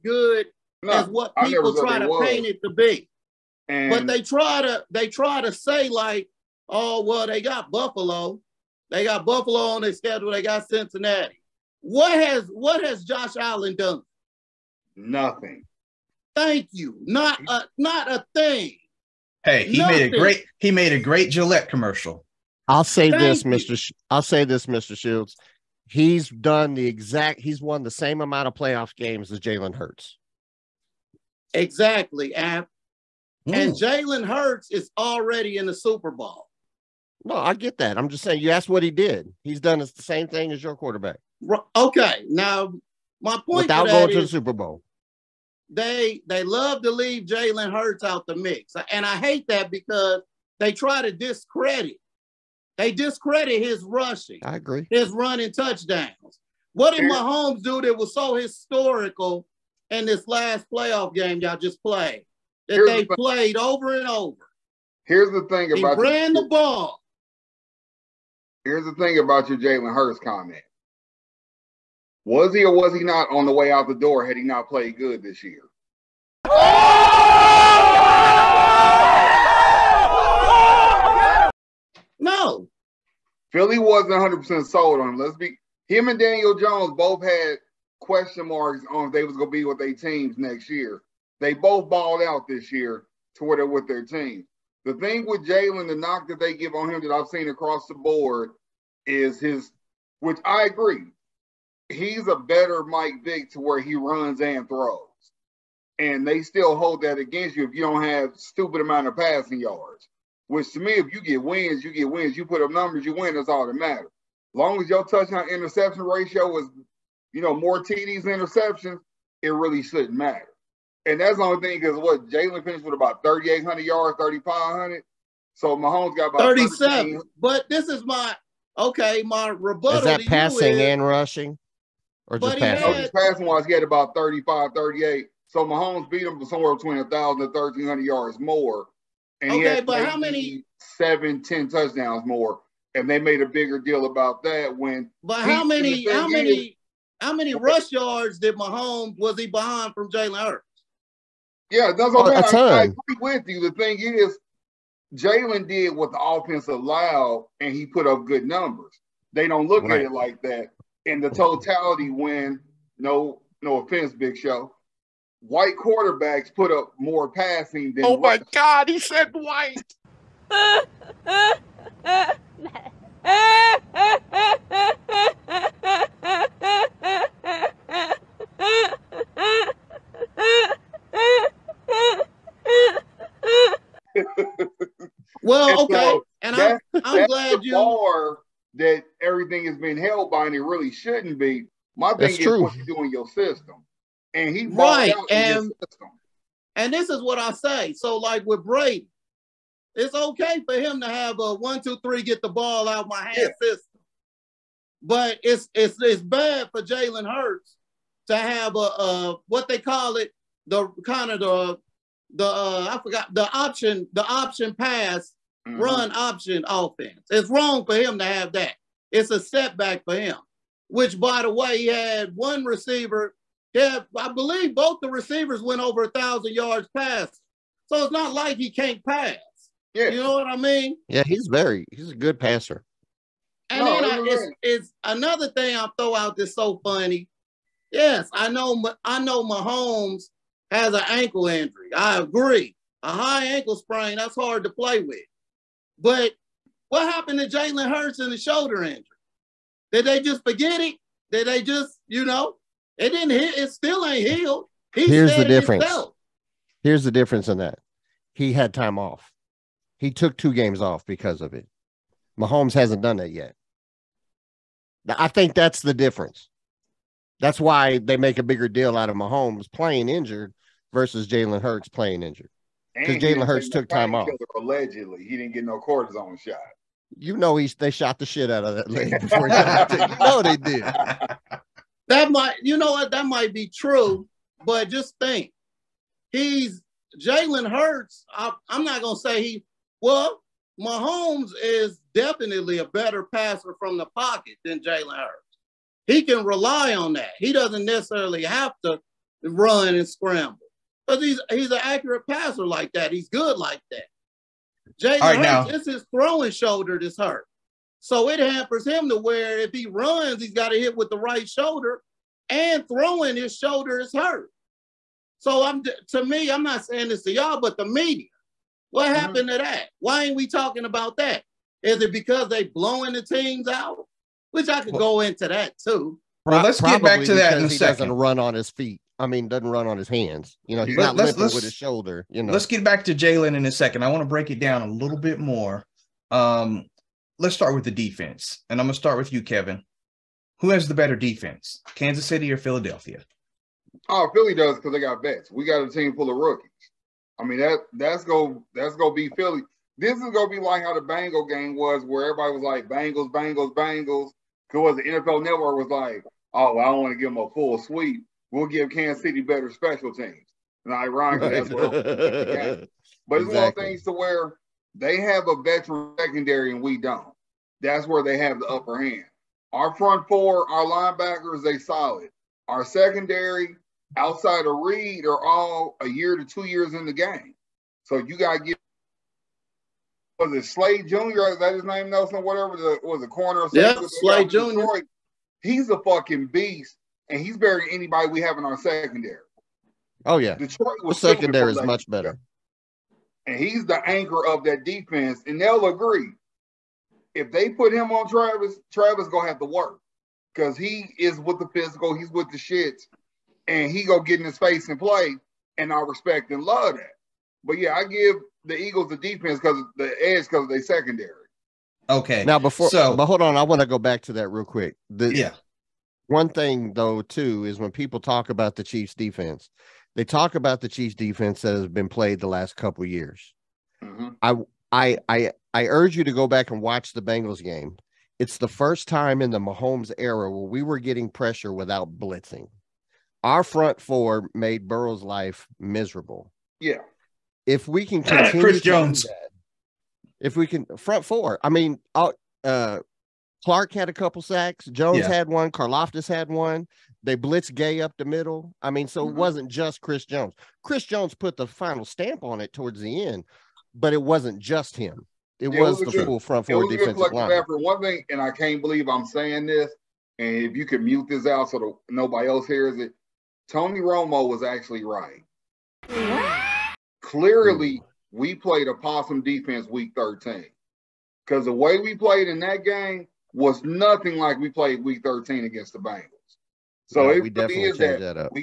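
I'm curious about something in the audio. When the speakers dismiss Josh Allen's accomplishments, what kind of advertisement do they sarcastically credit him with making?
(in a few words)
Gillette commercial.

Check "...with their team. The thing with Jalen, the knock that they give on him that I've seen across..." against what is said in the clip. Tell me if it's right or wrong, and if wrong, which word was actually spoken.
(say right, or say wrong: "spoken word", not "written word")
right.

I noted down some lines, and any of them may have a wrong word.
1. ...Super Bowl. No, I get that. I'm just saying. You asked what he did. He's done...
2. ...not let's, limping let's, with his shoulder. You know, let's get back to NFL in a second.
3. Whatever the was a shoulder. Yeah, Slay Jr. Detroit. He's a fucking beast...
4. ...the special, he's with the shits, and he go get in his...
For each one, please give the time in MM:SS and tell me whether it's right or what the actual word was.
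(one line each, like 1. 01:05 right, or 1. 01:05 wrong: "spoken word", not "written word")
1. 00:35 right
2. 05:30 wrong: "Jalen", not "NFL"
3. 06:22 wrong: "corner", not "shoulder"
4. 06:41 wrong: "physical", not "special".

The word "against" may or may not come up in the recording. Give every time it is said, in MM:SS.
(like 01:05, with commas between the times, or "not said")
01:47, 07:55.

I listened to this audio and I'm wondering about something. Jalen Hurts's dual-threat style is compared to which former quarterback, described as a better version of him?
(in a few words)
Mike Vick.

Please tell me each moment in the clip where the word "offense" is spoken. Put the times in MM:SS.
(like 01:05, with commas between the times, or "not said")
02:36, 02:43, 03:36.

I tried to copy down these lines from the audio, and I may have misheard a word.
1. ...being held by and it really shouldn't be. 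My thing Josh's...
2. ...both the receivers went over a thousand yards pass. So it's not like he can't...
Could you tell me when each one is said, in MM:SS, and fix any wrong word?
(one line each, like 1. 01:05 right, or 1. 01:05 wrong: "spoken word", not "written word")
1. 03:09 wrong: "That", not "Josh"
2. 03:44 right.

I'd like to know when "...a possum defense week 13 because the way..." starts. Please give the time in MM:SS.
07:48.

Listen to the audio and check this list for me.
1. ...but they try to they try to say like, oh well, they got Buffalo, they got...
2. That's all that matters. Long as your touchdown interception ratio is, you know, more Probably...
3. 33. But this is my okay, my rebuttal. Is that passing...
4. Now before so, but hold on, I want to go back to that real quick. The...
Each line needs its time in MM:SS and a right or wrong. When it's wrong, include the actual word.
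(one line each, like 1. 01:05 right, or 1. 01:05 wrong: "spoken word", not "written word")
1. 00:03 right
2. 01:53 wrong: "TDs", not "Probably"
3. 02:06 wrong: "13", not "33"
4. 06:52 right.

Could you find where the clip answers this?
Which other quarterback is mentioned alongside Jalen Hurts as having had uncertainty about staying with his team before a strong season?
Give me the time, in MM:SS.
01:26.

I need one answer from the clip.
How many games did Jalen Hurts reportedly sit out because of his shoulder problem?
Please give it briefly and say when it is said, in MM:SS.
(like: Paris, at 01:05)
2, at 04:20.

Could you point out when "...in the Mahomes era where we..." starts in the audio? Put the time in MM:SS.
07:09.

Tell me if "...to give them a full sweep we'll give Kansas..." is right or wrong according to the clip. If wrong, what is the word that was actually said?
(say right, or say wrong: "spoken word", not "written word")
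right.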